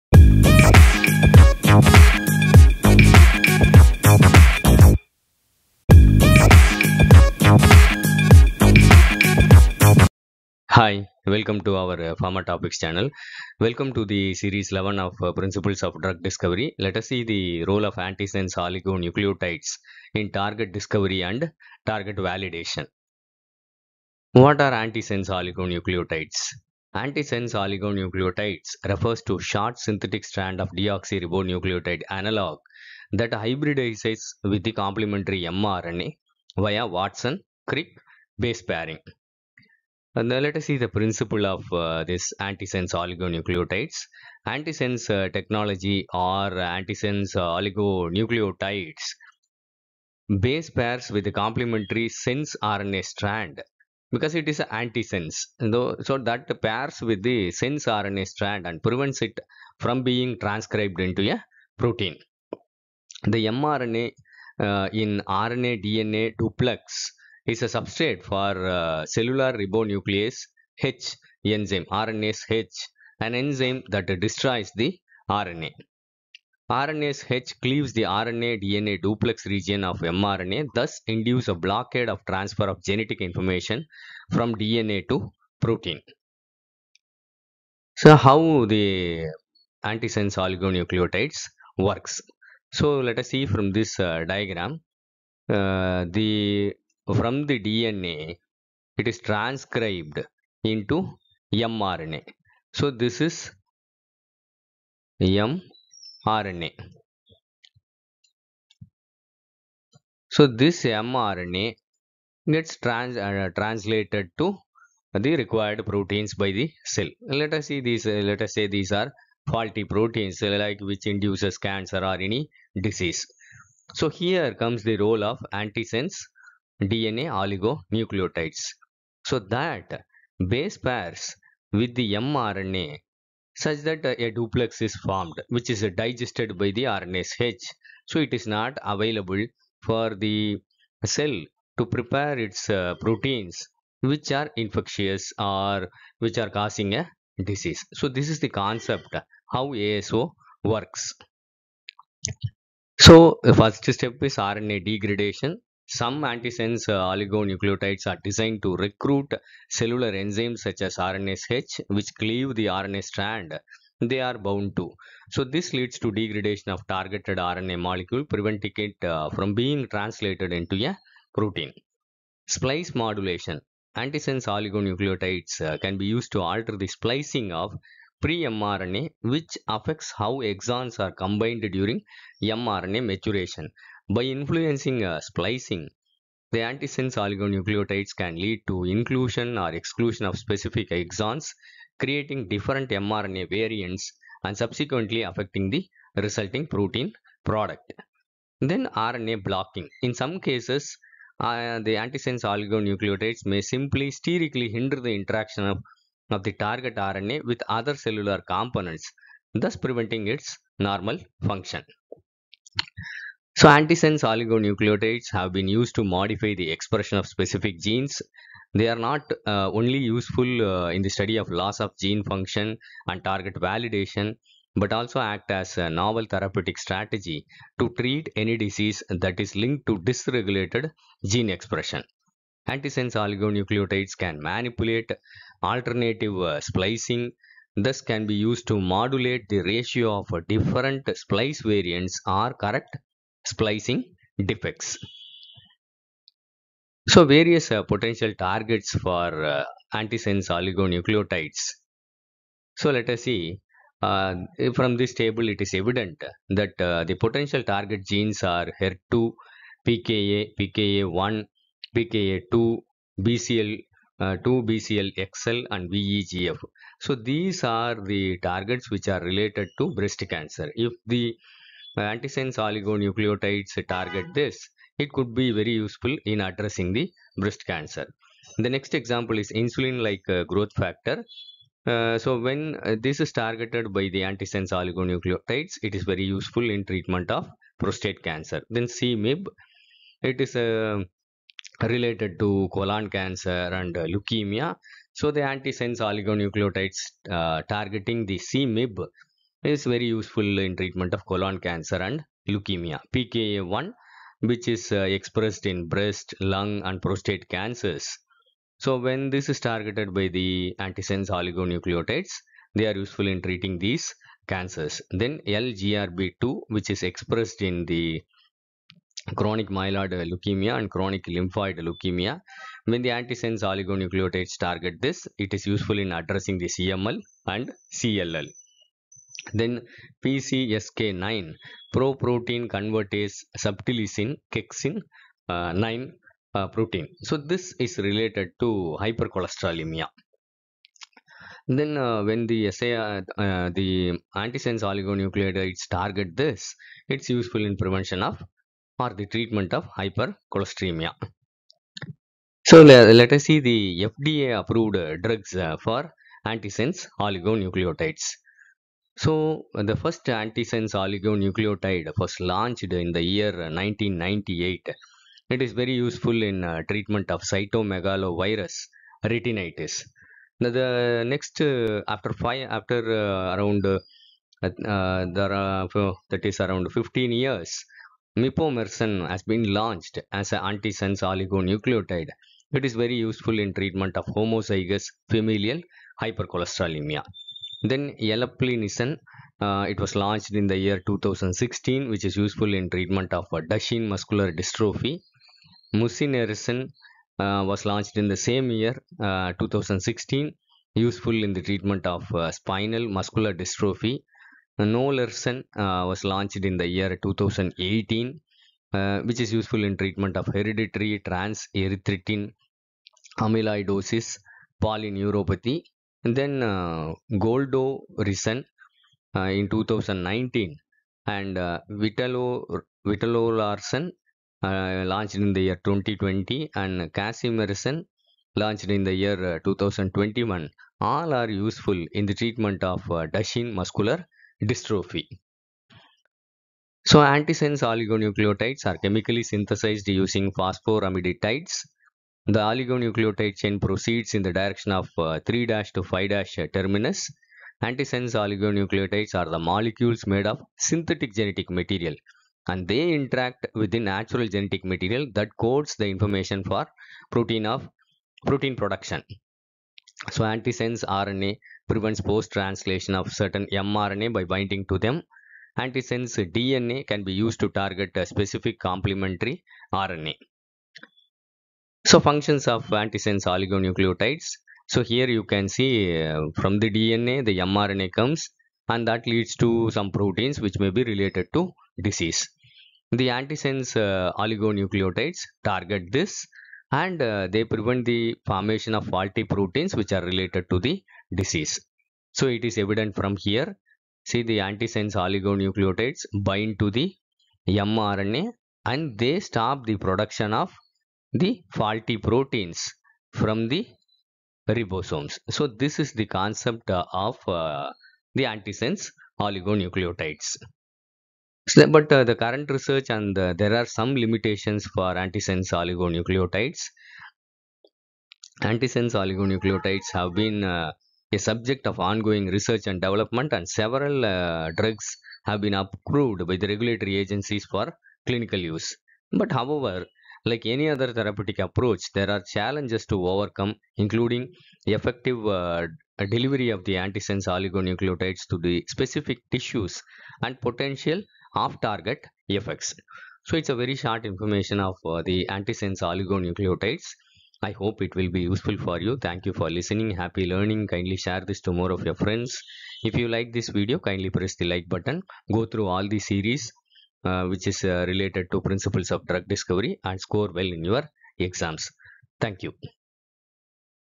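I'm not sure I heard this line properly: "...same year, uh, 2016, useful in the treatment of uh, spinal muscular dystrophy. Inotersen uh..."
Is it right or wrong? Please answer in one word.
right.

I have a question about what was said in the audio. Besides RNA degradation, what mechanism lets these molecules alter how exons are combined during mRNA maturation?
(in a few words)
Splice modulation.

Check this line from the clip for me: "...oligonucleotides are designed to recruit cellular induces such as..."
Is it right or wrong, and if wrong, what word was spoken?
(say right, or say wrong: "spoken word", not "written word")
wrong: "enzymes", not "induces".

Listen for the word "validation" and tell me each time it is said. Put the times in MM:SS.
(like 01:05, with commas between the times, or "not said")
00:22, 03:43.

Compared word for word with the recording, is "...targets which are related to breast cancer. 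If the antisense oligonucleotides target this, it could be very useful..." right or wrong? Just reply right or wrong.
right.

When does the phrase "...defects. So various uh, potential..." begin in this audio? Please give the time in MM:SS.
04:04.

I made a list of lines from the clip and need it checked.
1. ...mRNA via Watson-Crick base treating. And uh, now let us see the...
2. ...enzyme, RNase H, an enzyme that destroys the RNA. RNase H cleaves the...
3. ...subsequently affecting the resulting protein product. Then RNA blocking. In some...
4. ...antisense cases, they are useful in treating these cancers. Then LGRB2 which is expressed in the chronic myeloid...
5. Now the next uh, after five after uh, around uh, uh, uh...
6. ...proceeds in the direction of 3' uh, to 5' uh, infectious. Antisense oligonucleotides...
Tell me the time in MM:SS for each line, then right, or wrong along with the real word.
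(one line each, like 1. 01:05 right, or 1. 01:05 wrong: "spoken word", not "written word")
1. 00:35 wrong: "pairing", not "treating"
2. 01:11 right
3. 03:14 right
4. 05:10 wrong: "oligonucleotides", not "cases"
5. 06:10 right
6. 07:23 wrong: "terminus", not "infectious".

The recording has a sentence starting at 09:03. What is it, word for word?
So it's a very short information of uh, the antisense oligonucleotides.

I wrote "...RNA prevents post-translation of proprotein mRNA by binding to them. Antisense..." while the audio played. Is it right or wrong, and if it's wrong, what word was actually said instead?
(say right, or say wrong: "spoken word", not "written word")
wrong: "certain", not "proprotein".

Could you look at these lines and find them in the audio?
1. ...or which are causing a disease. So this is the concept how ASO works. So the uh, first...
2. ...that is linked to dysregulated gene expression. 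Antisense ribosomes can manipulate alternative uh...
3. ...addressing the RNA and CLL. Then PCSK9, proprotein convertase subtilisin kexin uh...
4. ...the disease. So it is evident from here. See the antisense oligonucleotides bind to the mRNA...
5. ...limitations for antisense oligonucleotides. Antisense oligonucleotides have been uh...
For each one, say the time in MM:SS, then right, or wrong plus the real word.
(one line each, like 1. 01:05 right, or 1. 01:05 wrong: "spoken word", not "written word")
1. 02:25 right
2. 03:49 wrong: "oligonucleotides", not "ribosomes"
3. 05:26 wrong: "CML", not "RNA"
4. 08:10 right
5. 08:34 right.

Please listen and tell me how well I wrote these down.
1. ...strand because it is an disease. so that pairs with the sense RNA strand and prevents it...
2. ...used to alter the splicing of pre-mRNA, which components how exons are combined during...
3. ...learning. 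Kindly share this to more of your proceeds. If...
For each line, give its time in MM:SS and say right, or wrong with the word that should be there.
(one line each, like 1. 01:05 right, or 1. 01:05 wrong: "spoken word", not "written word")
1. 00:53 wrong: "antisense", not "disease"
2. 02:56 wrong: "affects", not "components"
3. 09:10 wrong: "friends", not "proceeds".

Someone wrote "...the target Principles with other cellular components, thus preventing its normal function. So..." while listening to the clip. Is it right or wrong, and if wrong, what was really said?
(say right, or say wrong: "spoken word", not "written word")
wrong: "RNA", not "Principles".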